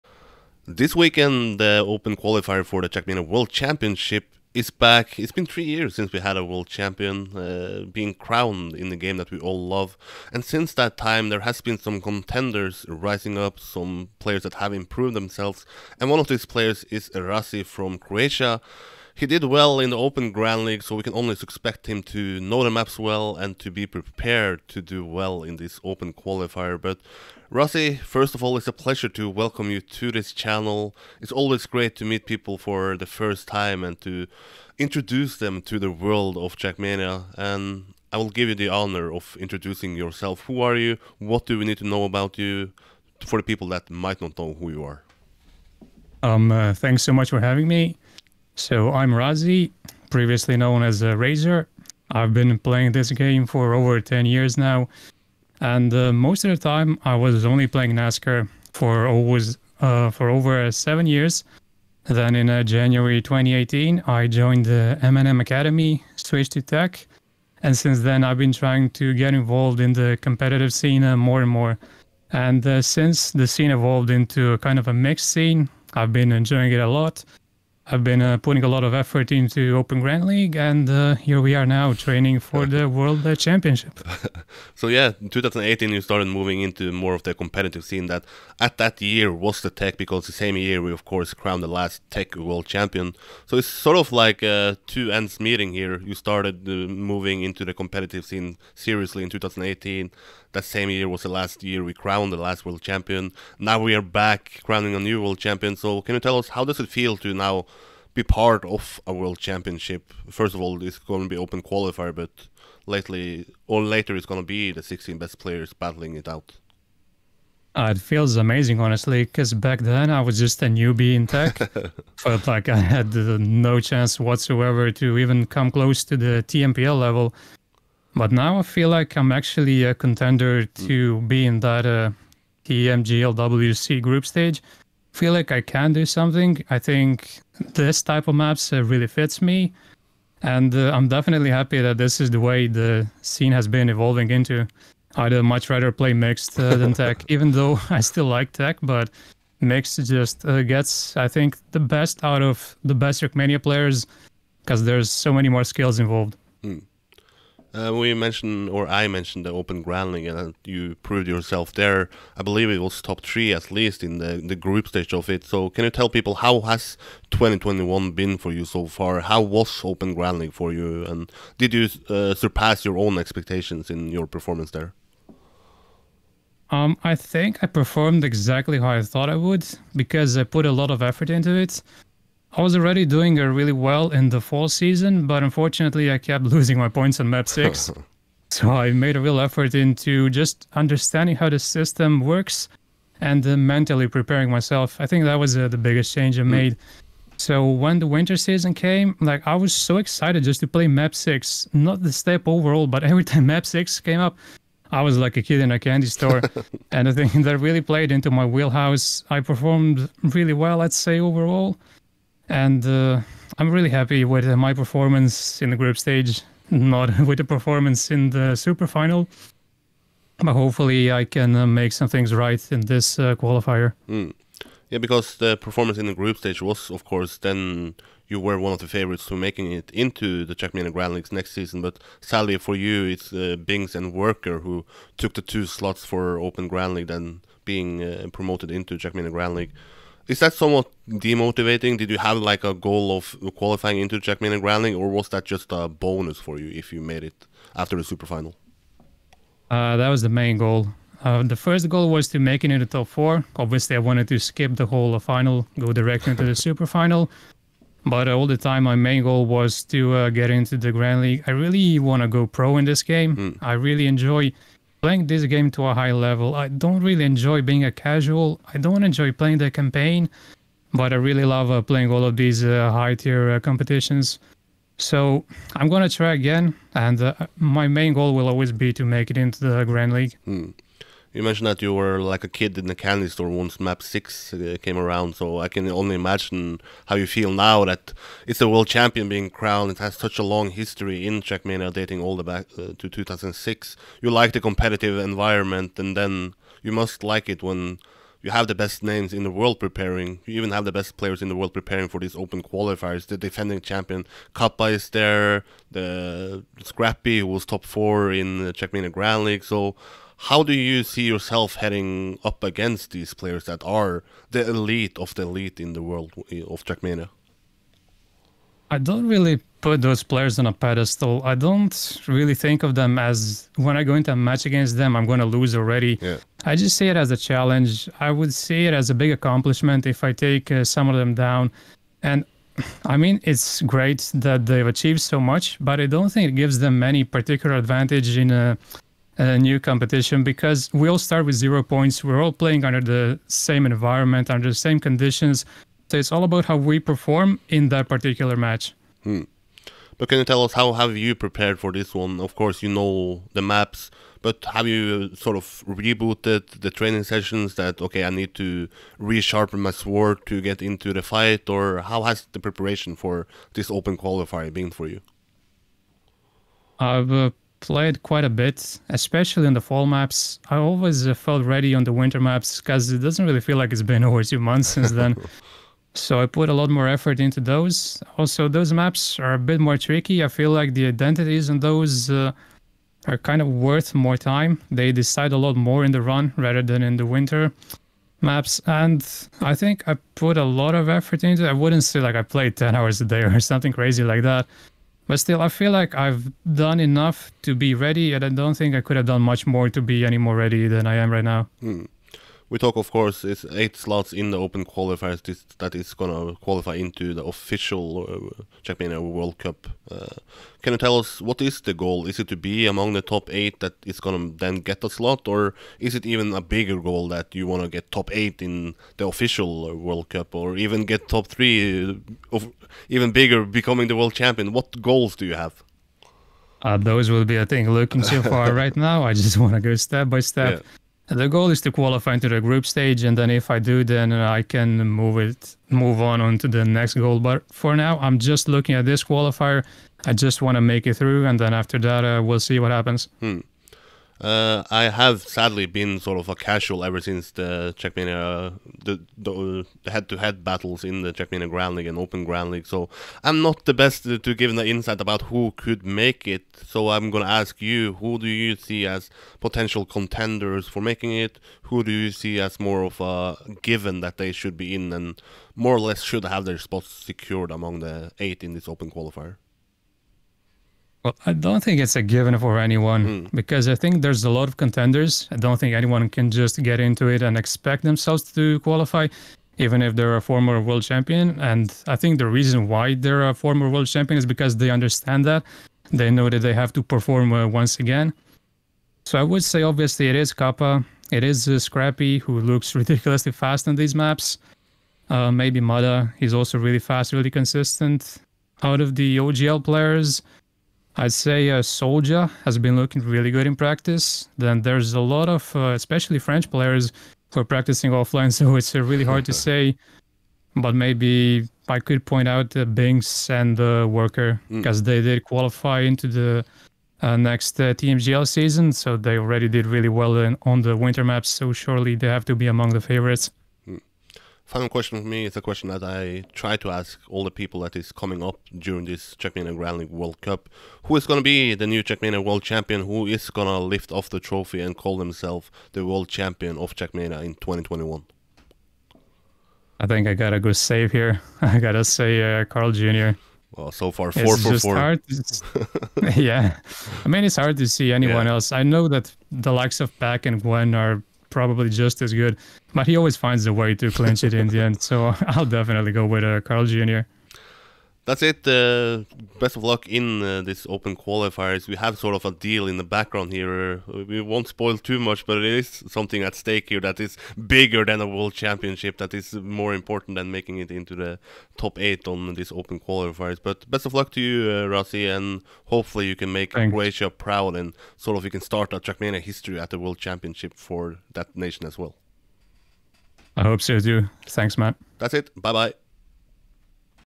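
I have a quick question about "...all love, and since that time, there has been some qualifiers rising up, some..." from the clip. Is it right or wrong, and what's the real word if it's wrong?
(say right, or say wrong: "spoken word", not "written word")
wrong: "contenders", not "qualifiers".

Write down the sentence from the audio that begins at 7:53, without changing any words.
because I think there's a lot of contenders.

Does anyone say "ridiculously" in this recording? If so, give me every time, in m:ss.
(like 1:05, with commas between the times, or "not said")
8:12.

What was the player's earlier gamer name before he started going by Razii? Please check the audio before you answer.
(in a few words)
Razor.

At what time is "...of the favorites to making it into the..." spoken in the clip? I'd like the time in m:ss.
3:48.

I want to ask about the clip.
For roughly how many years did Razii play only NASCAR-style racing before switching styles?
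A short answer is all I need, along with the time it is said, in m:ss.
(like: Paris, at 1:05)
7, at 1:00.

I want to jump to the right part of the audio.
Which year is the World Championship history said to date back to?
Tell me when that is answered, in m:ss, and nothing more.
4:53.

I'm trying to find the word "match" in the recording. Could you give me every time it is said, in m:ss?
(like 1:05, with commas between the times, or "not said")
5:24, 5:48.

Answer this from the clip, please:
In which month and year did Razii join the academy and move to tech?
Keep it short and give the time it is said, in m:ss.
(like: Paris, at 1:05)
January 2018, at 1:02.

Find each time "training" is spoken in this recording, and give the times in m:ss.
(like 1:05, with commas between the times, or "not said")
1:21, 5:56.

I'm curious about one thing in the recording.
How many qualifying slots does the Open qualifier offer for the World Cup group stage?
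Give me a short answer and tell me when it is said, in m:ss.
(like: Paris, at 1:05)
8, at 6:43.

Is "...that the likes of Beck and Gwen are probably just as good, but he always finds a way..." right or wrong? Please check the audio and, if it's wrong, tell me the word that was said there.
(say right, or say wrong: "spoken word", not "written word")
right.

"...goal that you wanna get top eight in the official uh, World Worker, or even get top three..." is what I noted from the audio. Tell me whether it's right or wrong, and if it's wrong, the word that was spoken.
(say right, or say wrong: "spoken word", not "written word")
wrong: "Cup", not "Worker".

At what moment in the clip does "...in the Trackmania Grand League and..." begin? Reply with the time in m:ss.
7:31.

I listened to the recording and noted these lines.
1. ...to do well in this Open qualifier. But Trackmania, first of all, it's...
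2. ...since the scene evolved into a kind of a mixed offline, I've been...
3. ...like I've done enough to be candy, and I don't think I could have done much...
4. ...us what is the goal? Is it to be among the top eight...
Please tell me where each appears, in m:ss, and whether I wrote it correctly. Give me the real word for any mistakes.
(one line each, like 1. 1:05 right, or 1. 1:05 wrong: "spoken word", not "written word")
1. 0:24 wrong: "Razii", not "Trackmania"
2. 1:12 wrong: "scene", not "offline"
3. 6:35 wrong: "ready", not "candy"
4. 6:51 right.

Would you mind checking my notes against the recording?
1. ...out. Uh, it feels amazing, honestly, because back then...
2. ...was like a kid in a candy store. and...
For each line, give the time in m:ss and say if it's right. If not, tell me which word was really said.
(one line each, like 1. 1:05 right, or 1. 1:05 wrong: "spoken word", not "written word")
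1. 1:56 right
2. 3:25 right.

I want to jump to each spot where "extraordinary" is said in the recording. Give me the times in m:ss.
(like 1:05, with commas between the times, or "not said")
not said.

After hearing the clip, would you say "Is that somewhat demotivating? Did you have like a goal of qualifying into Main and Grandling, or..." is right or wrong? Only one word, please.
right.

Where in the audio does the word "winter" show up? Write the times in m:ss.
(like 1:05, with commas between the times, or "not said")
3:18, 6:12, 6:27, 8:40.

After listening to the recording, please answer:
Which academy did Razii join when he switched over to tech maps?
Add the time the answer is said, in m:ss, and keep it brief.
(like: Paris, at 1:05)
M&M Academy, at 1:05.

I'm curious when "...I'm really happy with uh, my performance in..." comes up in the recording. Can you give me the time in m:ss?
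3:33.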